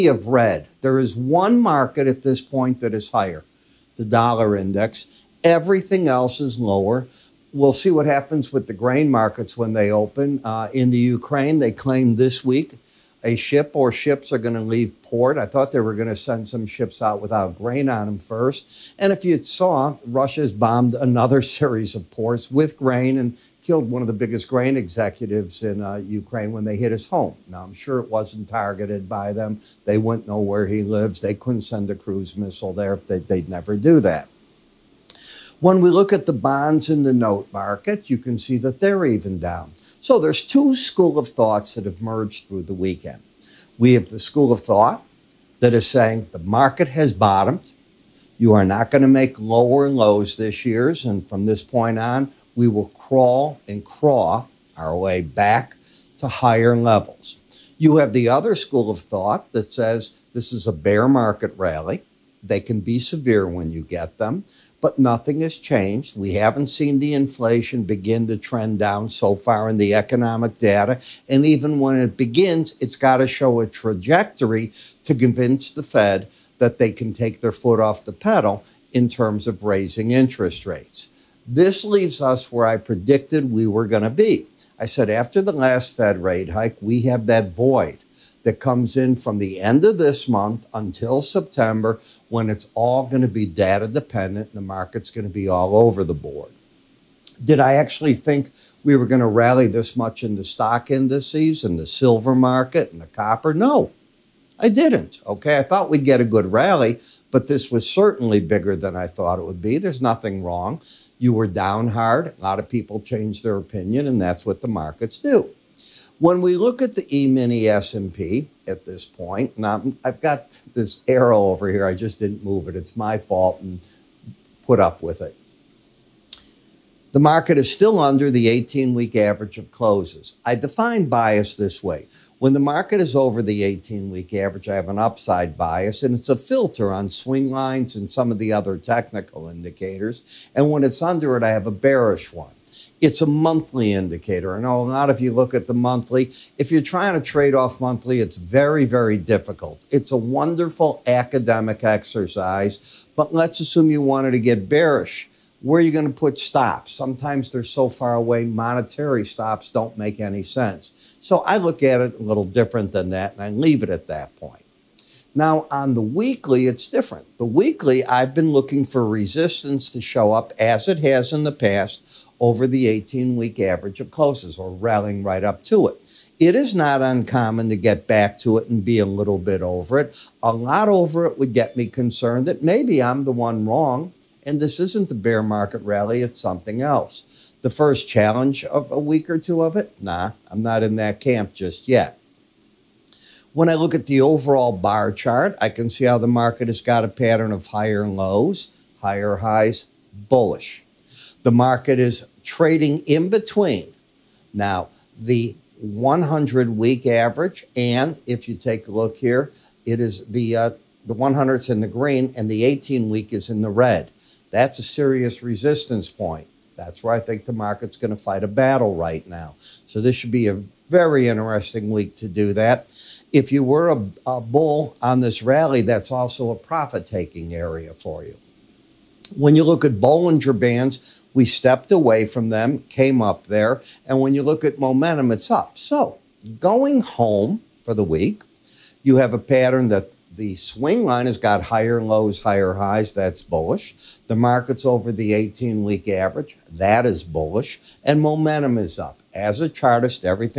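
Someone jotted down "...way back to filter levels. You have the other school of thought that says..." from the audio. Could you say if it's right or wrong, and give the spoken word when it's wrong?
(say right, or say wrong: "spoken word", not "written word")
wrong: "higher", not "filter".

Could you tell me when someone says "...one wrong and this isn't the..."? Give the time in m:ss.
3:03.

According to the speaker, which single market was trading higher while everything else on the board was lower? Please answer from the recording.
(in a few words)
Dollar index.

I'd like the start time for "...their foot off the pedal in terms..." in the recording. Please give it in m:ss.
1:17.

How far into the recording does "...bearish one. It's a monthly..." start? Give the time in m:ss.
2:21.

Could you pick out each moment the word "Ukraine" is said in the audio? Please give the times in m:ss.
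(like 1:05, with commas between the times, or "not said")
0:10, 0:25.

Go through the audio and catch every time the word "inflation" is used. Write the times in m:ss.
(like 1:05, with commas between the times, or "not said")
1:07.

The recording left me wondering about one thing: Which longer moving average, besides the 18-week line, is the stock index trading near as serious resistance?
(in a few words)
100 week average.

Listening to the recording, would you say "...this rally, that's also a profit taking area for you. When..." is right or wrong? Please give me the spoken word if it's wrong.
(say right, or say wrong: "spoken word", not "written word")
right.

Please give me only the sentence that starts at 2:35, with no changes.
Where are you going to put stops?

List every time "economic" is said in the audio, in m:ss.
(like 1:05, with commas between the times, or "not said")
1:09.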